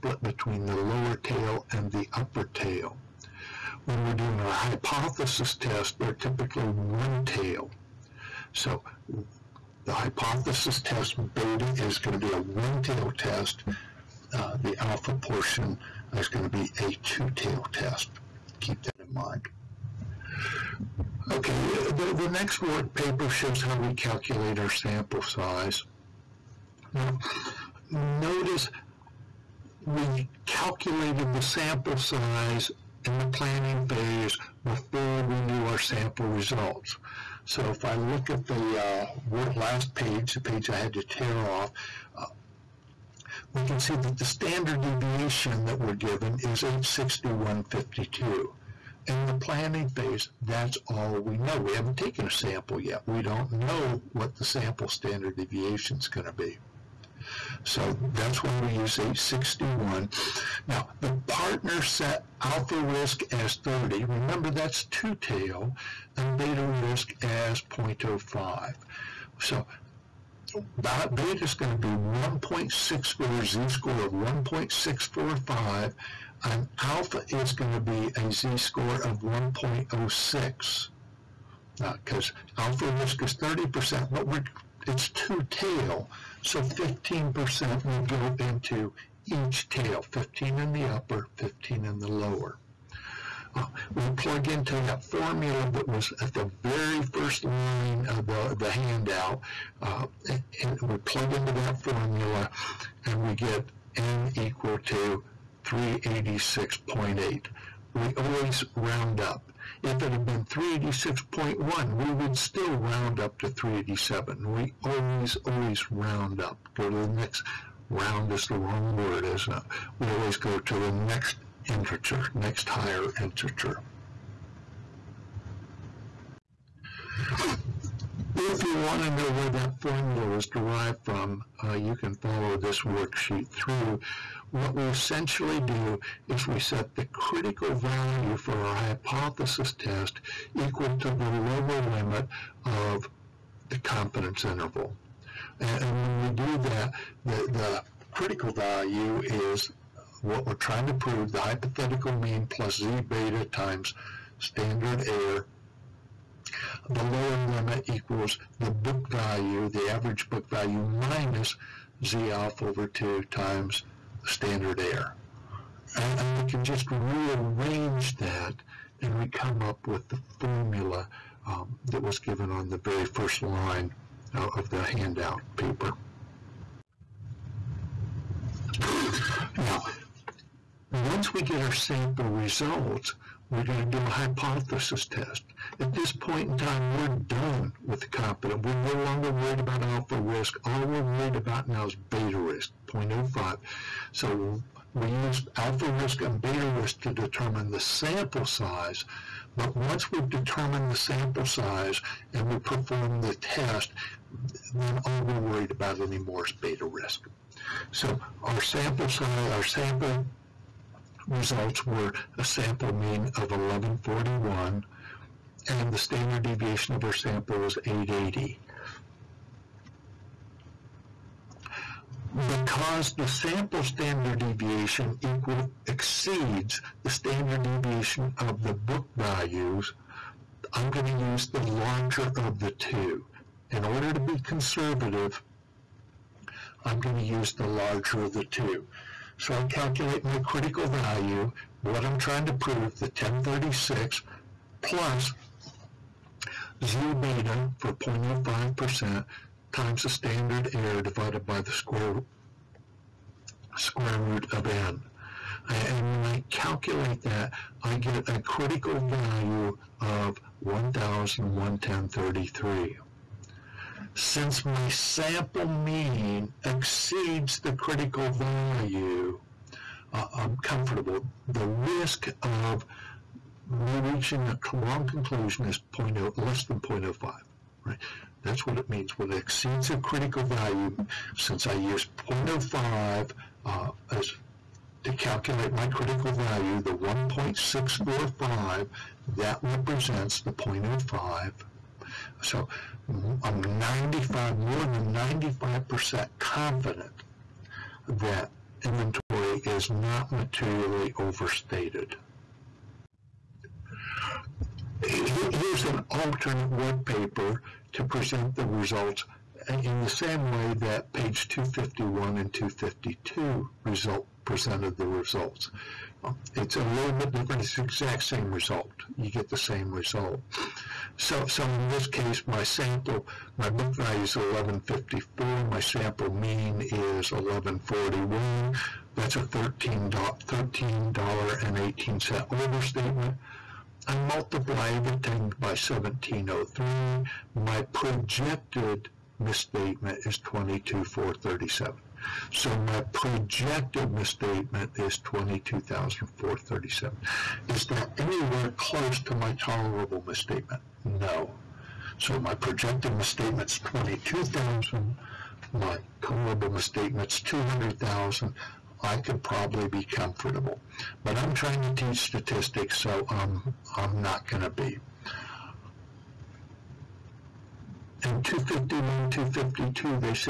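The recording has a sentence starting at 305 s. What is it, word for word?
Here's an alternate work paper to present the results in the same way that page 251 and 252 result presented the results.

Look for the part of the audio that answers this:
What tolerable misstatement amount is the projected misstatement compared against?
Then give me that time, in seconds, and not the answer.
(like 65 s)
357 s.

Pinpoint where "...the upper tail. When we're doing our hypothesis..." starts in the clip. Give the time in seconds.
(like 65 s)
1 s.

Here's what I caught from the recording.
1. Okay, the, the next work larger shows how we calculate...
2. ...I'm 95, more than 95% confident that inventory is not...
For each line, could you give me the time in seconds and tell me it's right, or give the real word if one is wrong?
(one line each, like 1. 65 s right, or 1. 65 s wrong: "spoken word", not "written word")
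1. 21 s wrong: "paper", not "larger"
2. 293 s right.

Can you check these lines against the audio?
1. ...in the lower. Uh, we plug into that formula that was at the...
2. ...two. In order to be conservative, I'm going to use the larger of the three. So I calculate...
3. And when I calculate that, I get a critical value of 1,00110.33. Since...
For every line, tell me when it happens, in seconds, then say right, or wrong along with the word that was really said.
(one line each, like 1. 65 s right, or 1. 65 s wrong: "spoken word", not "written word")
1. 91 s right
2. 232 s wrong: "two", not "three"
3. 255 s right.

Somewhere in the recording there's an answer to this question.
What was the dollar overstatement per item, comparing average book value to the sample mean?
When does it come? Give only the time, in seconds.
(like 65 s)
329 s.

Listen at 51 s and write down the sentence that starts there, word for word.
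We haven't taken a sample yet.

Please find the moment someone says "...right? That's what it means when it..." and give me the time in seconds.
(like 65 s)
277 s.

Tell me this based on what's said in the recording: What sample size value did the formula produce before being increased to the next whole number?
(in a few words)
386.8.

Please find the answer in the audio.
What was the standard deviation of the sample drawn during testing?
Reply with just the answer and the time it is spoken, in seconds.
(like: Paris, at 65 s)
880, at 217 s.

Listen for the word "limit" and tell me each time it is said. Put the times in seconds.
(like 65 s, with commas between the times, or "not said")
141 s, 157 s.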